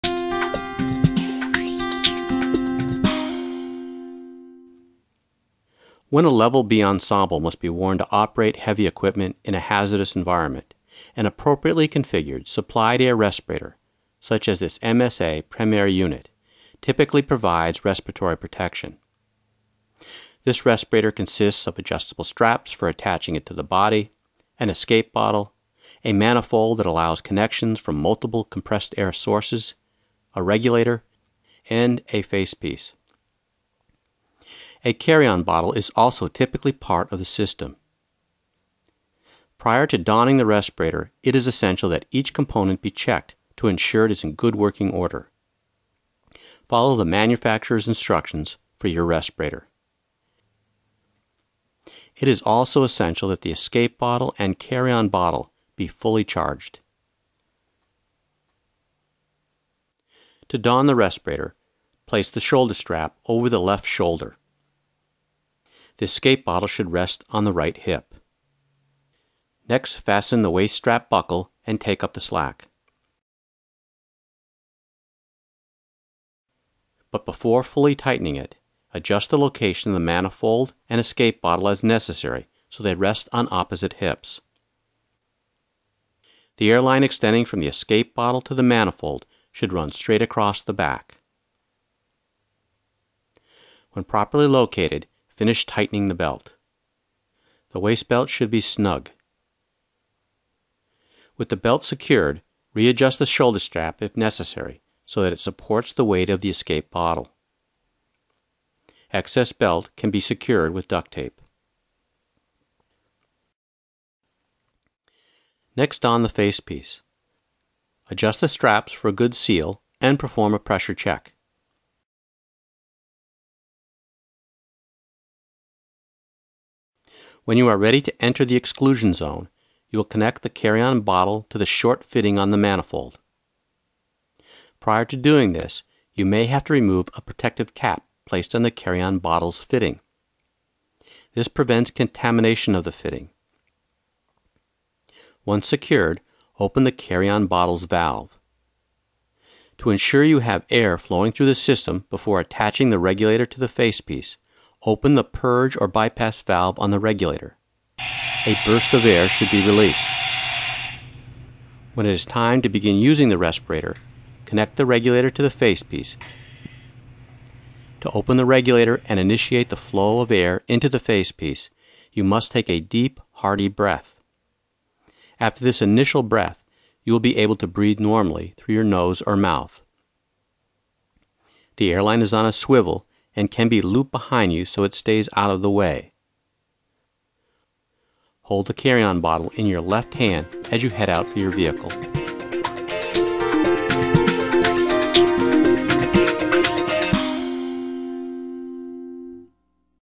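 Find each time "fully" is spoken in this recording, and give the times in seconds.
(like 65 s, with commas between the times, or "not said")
55 s, 77 s.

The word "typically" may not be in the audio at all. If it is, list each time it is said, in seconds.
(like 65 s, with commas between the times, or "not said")
16 s, 36 s.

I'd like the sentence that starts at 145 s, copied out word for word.
Once secured, open the carry-on bottle's valve.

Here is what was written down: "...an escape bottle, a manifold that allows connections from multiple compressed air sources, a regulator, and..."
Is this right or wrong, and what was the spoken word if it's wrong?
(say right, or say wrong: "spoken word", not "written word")
right.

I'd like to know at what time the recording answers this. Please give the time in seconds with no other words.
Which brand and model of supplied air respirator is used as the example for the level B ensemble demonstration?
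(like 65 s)
14 s.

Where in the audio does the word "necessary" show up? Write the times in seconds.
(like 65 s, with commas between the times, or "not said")
81 s, 104 s.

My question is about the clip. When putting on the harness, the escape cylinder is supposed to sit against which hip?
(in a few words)
Right hip.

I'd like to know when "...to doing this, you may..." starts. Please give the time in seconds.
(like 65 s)
135 s.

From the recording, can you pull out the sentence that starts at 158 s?
A burst of air should be released.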